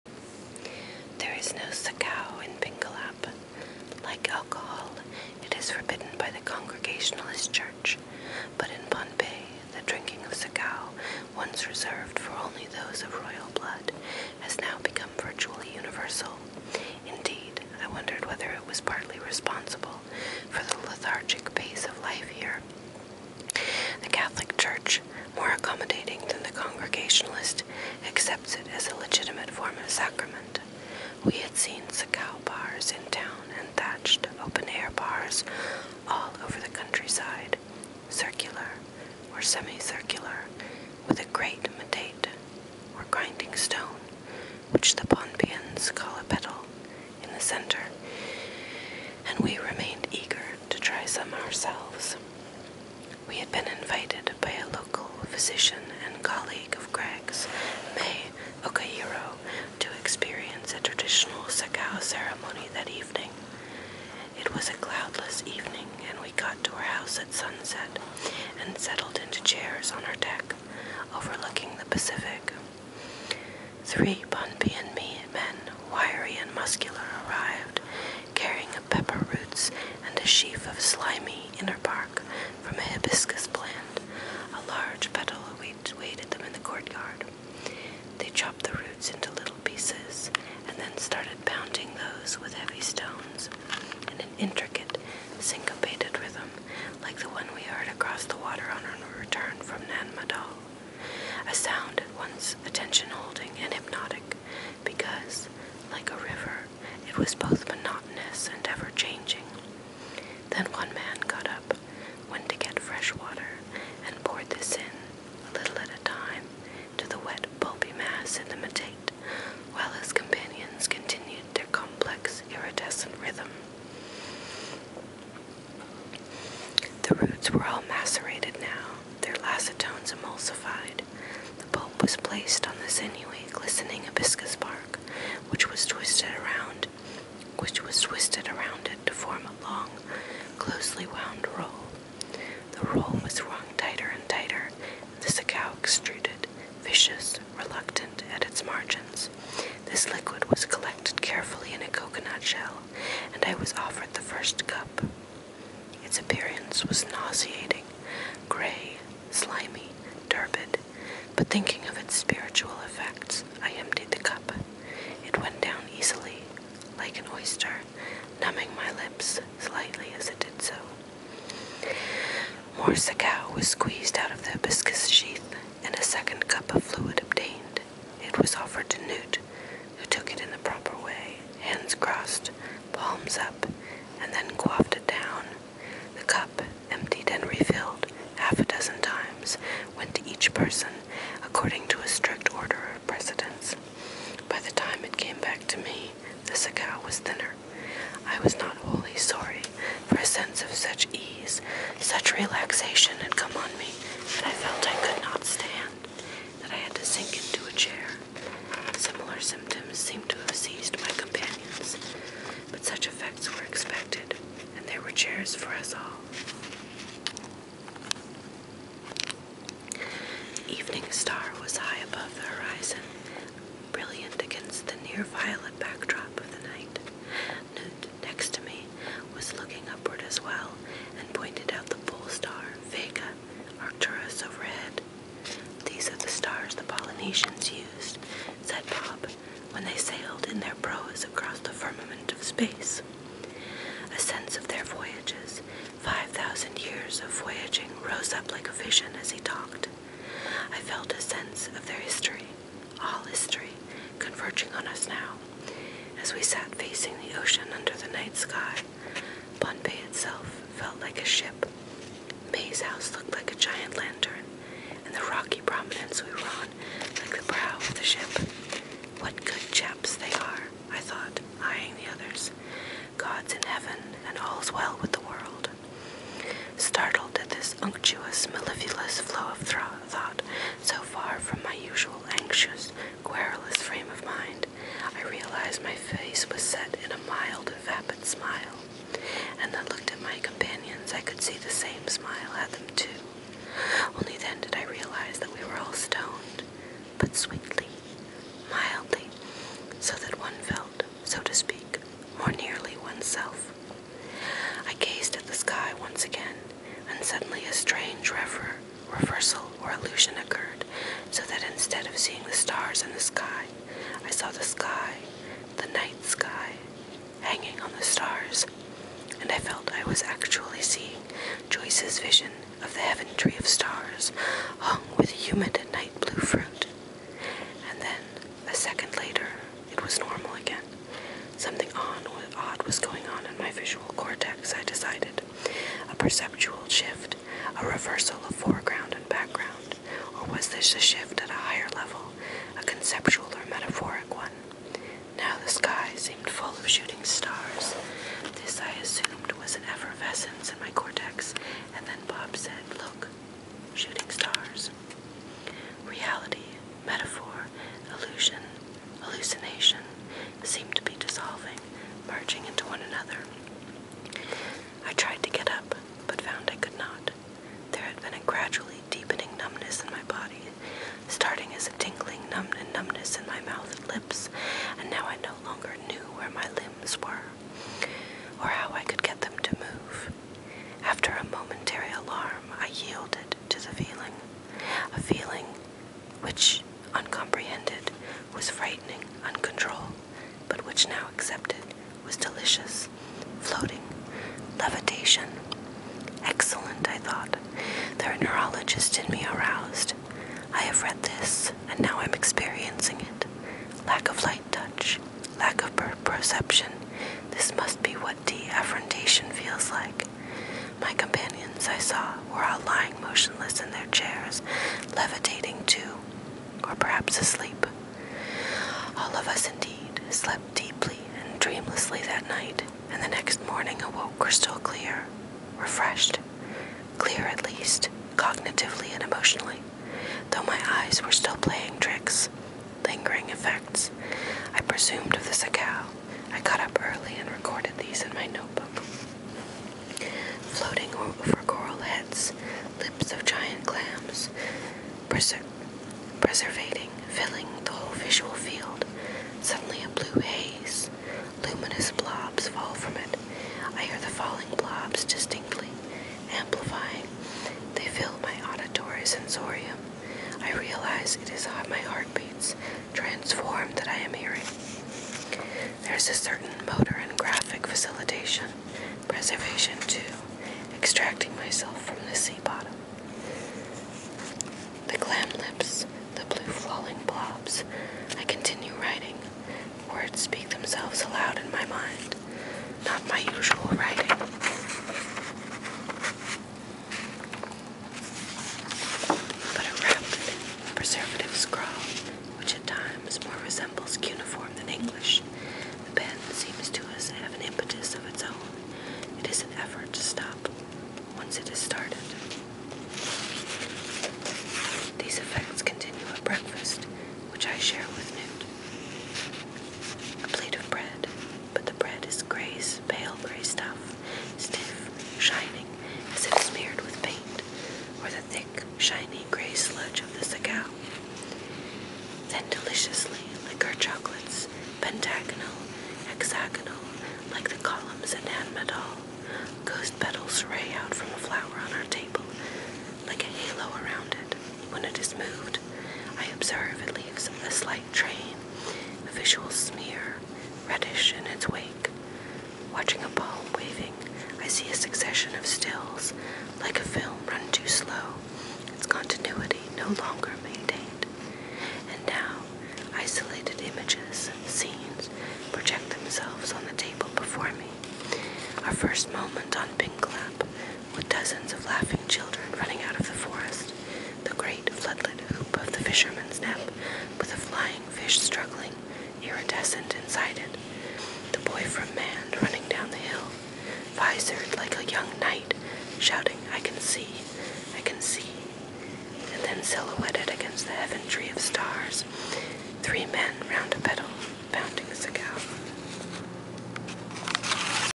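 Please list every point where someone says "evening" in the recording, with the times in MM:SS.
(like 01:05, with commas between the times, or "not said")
01:05, 03:40.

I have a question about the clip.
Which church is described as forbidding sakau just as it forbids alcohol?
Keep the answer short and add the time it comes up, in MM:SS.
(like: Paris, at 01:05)
Congregationalist Church, at 00:06.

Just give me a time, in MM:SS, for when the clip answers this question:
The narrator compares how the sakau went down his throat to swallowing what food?
02:47.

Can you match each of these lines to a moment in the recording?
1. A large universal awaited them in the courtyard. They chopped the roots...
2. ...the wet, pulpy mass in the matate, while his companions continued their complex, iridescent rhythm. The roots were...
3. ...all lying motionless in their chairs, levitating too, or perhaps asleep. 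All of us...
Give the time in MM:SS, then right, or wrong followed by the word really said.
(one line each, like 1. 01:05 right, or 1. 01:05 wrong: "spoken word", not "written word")
1. 01:24 wrong: "petal", not "universal"
2. 01:57 right
3. 06:52 right.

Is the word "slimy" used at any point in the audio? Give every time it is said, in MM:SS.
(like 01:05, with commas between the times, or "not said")
01:20, 02:39.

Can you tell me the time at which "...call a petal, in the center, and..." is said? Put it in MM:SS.
00:45.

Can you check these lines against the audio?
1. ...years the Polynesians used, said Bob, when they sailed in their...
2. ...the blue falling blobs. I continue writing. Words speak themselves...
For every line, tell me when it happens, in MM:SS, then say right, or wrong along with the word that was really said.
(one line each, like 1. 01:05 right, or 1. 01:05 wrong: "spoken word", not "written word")
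1. 03:56 wrong: "stars", not "years"
2. 07:56 right.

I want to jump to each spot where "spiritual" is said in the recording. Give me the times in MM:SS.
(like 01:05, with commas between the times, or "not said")
02:42.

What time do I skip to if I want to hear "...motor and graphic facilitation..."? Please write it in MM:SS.
07:46.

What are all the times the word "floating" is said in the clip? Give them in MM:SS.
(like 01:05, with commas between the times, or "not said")
06:33, 07:20.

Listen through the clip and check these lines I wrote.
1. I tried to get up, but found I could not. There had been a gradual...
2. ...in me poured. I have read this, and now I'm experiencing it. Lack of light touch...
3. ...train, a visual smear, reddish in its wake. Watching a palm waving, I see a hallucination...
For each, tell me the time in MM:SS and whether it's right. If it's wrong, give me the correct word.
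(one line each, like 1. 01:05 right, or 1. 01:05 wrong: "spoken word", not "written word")
1. 06:05 right
2. 06:39 wrong: "aroused", not "poured"
3. 08:58 wrong: "succession", not "hallucination".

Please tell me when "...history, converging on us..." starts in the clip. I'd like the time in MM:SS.
04:13.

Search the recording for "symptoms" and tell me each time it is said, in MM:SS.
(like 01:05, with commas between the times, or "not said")
03:29.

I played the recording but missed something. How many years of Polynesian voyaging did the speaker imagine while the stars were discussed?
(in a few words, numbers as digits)
5,000.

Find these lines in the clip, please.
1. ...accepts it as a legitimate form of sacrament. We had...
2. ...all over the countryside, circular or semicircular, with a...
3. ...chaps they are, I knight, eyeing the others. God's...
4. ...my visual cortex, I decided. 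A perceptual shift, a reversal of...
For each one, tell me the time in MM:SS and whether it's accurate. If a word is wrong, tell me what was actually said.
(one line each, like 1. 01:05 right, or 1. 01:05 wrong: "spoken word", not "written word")
1. 00:28 right
2. 00:36 right
3. 04:29 wrong: "thought", not "knight"
4. 05:33 right.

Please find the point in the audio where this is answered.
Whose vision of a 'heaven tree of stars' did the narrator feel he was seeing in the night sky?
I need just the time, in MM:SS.
05:21.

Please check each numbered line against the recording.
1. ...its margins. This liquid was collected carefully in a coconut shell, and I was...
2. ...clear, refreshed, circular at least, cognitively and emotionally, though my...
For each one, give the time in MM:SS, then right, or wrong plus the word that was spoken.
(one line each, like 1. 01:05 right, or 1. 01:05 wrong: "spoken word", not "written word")
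1. 02:28 right
2. 07:04 wrong: "clear", not "circular".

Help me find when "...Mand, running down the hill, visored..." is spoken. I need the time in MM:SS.
09:32.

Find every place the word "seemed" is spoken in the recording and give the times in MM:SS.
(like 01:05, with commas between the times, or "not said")
03:29, 05:46, 06:00.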